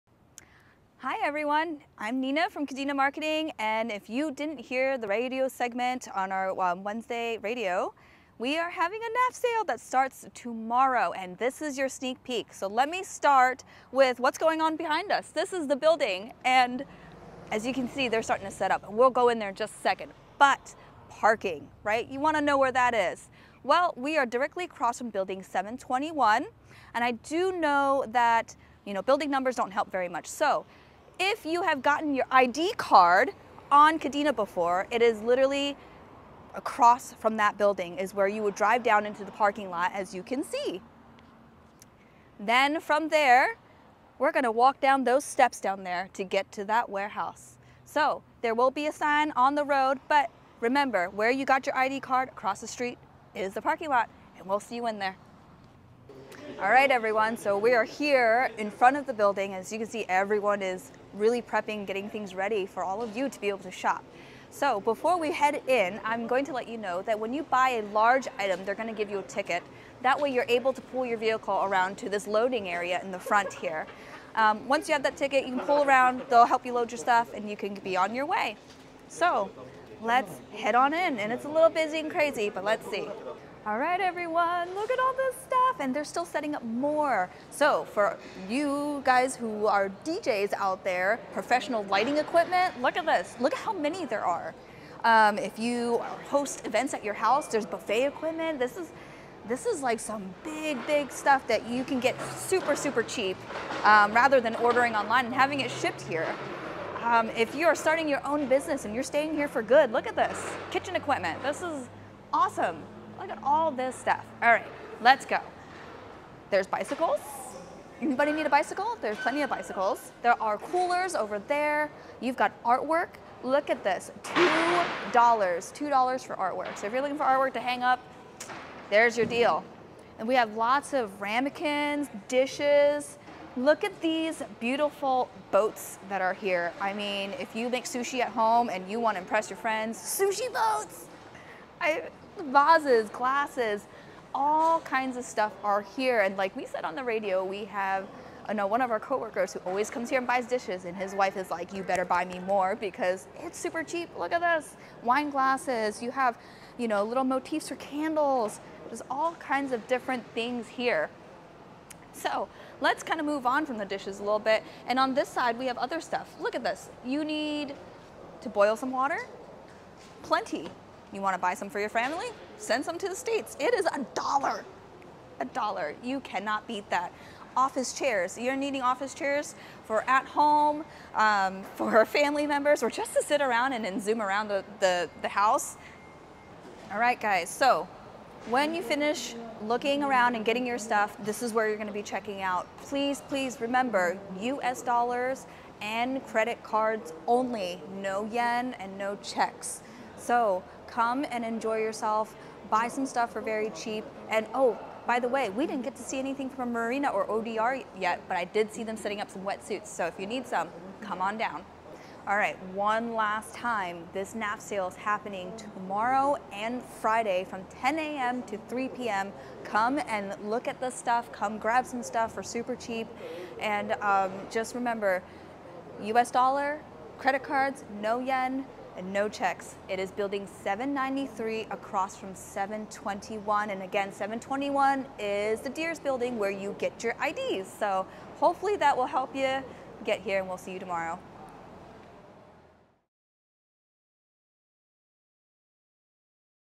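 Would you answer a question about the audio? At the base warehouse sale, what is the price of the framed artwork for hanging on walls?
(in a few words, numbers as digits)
$2.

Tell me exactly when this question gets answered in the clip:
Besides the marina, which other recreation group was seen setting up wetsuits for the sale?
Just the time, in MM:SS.
03:27.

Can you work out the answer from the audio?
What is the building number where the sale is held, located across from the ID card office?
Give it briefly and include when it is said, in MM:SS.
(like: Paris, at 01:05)
793, at 03:50.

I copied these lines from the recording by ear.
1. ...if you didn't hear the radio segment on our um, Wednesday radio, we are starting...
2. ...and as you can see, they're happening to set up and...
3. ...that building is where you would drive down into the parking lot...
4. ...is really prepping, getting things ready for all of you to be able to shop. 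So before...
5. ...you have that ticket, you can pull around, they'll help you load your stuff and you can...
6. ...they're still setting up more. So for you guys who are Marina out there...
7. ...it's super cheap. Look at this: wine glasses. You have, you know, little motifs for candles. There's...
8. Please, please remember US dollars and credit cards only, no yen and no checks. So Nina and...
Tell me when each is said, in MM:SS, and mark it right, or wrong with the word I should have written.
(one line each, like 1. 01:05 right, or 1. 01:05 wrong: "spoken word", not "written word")
1. 00:03 wrong: "having", not "starting"
2. 00:16 wrong: "starting", not "happening"
3. 00:37 right
4. 01:00 right
5. 01:14 right
6. 01:25 wrong: "DJs", not "Marina"
7. 02:33 right
8. 03:12 wrong: "Come", not "Nina".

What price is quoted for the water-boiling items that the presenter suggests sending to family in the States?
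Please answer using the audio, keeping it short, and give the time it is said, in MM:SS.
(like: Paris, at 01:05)
$1, at 02:53.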